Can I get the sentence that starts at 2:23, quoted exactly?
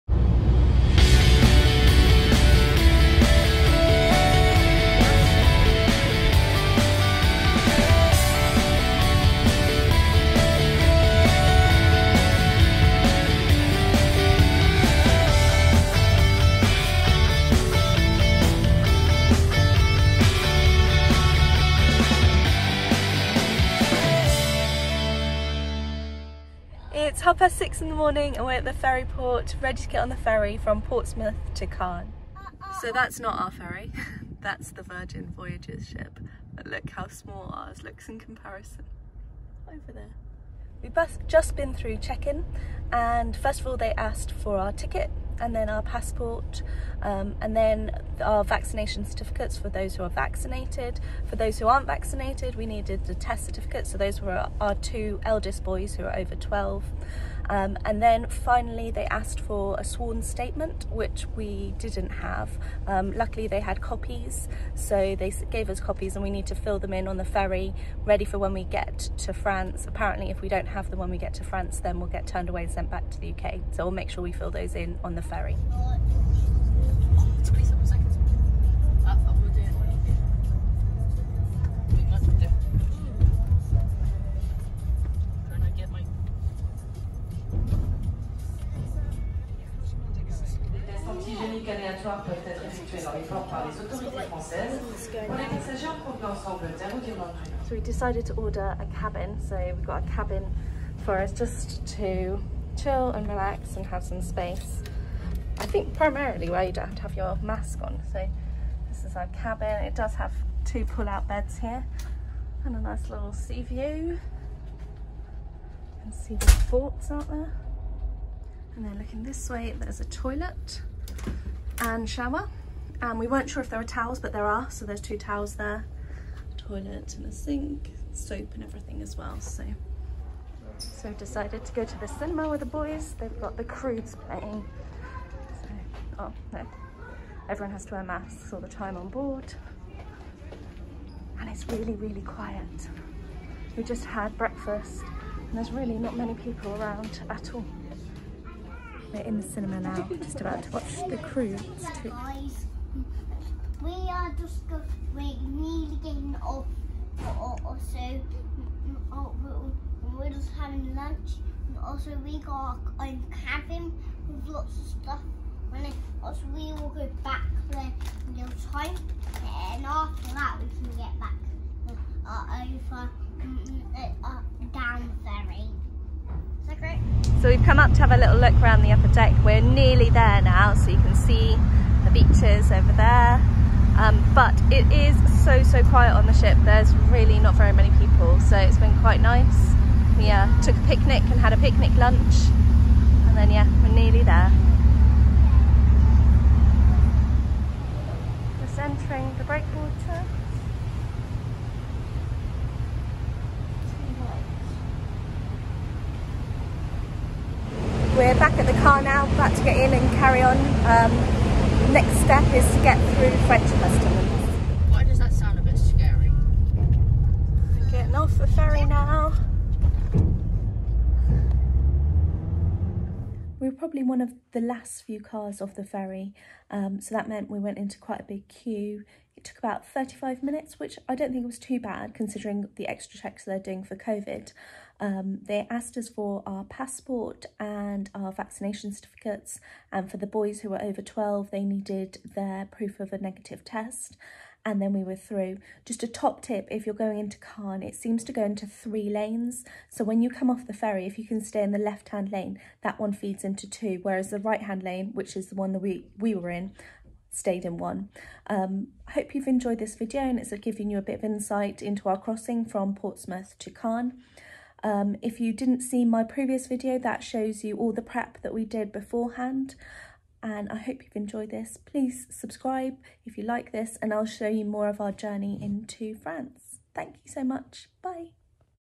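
We just had breakfast and there's really not many people around at all.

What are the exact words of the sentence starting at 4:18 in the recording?
Um, hope you've enjoyed this video and it's given you a bit of insight into our crossing from Portsmouth to Caen.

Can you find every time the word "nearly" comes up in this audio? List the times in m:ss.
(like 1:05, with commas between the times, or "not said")
2:35, 2:59, 3:13.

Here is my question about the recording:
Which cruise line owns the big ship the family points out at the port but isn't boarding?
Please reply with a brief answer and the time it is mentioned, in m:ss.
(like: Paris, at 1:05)
Virgin Voyages, at 0:34.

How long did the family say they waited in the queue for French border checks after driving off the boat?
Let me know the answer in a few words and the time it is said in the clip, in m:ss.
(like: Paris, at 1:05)
35 minutes, at 3:49.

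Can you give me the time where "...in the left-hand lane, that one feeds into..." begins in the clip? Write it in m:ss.
4:11.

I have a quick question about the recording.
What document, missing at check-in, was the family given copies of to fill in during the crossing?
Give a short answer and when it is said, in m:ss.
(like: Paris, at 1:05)
Sworn statement, at 0:59.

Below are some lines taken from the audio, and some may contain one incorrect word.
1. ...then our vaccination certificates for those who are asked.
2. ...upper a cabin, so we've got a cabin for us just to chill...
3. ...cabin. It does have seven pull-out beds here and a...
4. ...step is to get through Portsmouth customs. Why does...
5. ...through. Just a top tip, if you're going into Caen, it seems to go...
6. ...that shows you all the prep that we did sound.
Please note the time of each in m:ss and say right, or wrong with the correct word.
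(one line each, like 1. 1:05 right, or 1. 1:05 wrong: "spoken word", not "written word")
1. 0:47 wrong: "vaccinated", not "asked"
2. 1:38 wrong: "order", not "upper"
3. 1:49 wrong: "two", not "seven"
4. 3:32 wrong: "French", not "Portsmouth"
5. 4:05 right
6. 4:26 wrong: "beforehand", not "sound".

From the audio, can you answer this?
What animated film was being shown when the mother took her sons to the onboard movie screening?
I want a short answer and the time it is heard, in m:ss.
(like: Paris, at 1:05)
The Croods, at 2:13.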